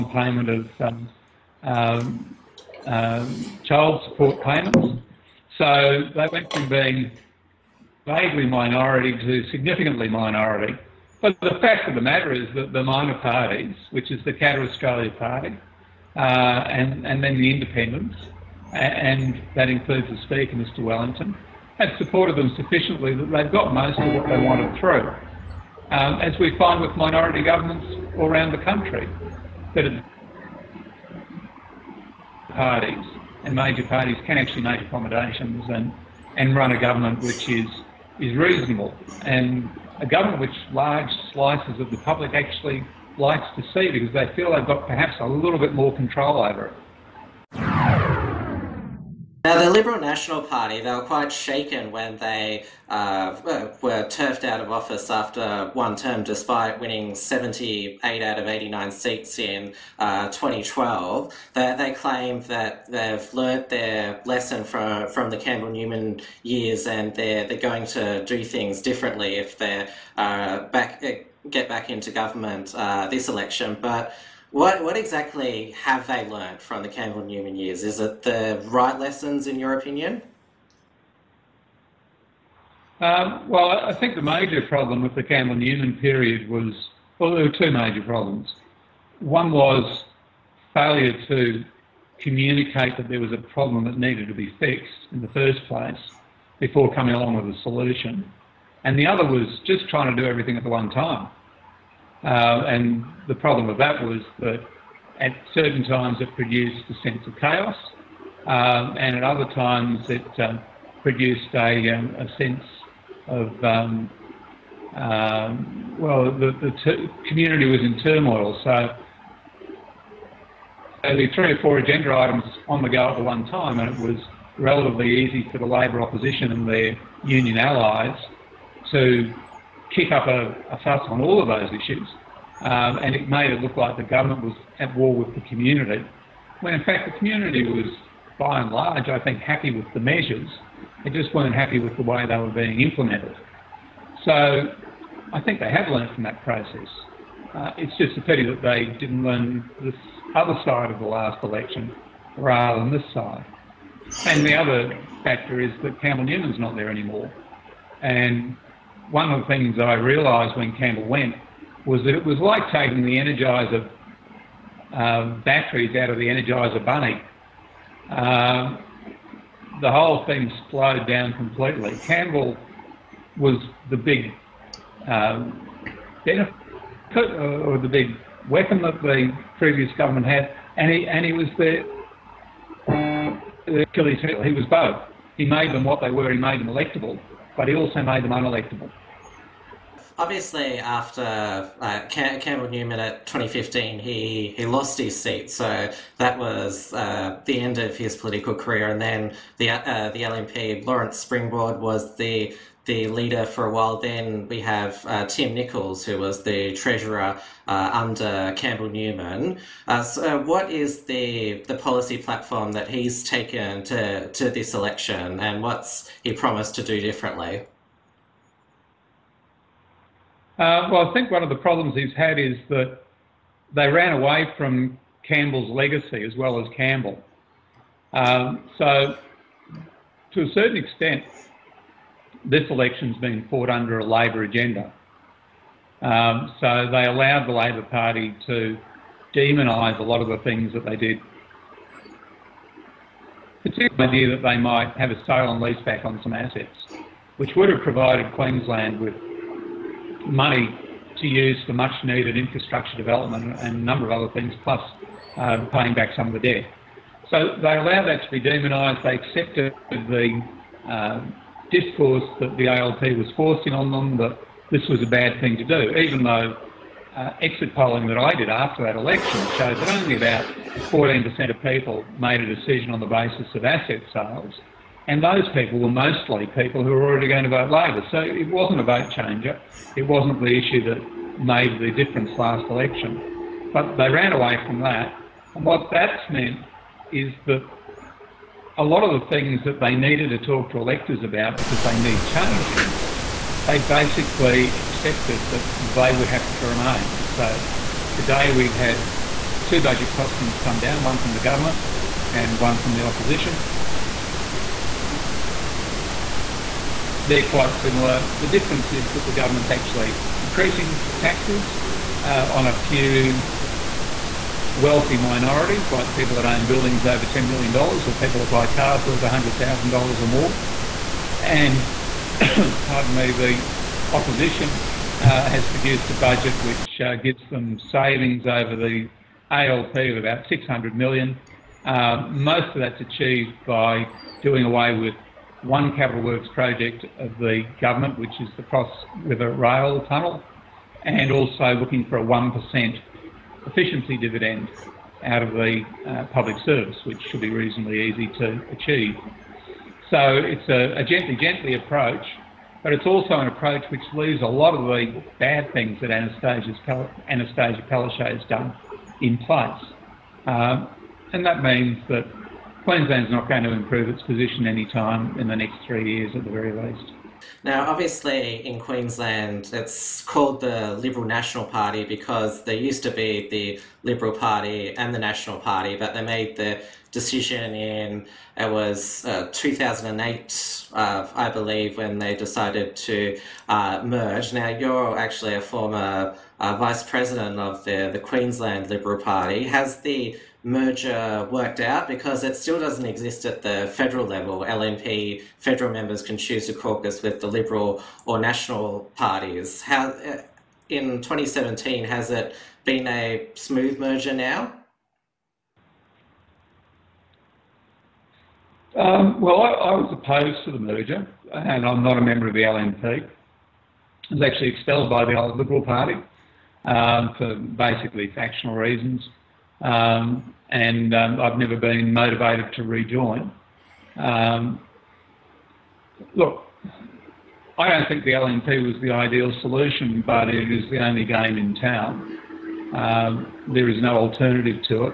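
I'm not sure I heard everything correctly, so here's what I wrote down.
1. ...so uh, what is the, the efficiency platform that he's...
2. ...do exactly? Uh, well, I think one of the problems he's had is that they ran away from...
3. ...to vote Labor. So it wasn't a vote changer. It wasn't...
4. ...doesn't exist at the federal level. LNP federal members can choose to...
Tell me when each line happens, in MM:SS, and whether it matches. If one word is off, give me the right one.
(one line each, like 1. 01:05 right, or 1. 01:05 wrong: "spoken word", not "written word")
1. 03:30 wrong: "policy", not "efficiency"
2. 03:36 wrong: "differently", not "exactly"
3. 04:37 right
4. 06:32 right.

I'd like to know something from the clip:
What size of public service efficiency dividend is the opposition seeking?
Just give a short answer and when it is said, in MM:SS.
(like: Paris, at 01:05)
1%, at 05:42.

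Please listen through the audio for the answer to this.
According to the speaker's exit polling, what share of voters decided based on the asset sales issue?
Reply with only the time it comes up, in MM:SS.
04:30.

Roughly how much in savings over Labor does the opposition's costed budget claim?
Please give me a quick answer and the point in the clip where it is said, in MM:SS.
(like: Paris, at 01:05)
600 million, at 05:30.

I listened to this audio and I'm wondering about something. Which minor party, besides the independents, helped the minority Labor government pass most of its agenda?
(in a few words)
Katter Australia Party.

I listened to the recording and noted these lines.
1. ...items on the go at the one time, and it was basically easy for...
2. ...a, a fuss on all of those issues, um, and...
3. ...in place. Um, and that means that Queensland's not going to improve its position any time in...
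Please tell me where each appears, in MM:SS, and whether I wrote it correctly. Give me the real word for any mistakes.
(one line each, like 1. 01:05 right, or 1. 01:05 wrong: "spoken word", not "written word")
1. 02:02 wrong: "relatively", not "basically"
2. 02:10 right
3. 05:59 right.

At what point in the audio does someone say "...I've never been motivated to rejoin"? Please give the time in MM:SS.
07:01.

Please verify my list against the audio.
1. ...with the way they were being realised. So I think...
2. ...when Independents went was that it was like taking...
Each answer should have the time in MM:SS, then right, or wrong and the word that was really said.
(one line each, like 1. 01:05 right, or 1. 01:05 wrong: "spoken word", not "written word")
1. 02:21 wrong: "implemented", not "realised"
2. 02:40 wrong: "Campbell", not "Independents".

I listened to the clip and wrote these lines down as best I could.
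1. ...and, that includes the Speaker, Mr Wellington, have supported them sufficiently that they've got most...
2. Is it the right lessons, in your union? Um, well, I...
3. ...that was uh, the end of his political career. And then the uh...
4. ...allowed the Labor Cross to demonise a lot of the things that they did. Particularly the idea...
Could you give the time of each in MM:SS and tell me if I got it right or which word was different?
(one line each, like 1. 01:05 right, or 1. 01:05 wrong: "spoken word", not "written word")
1. 00:18 right
2. 01:17 wrong: "opinion", not "union"
3. 03:16 right
4. 03:57 wrong: "Party", not "Cross".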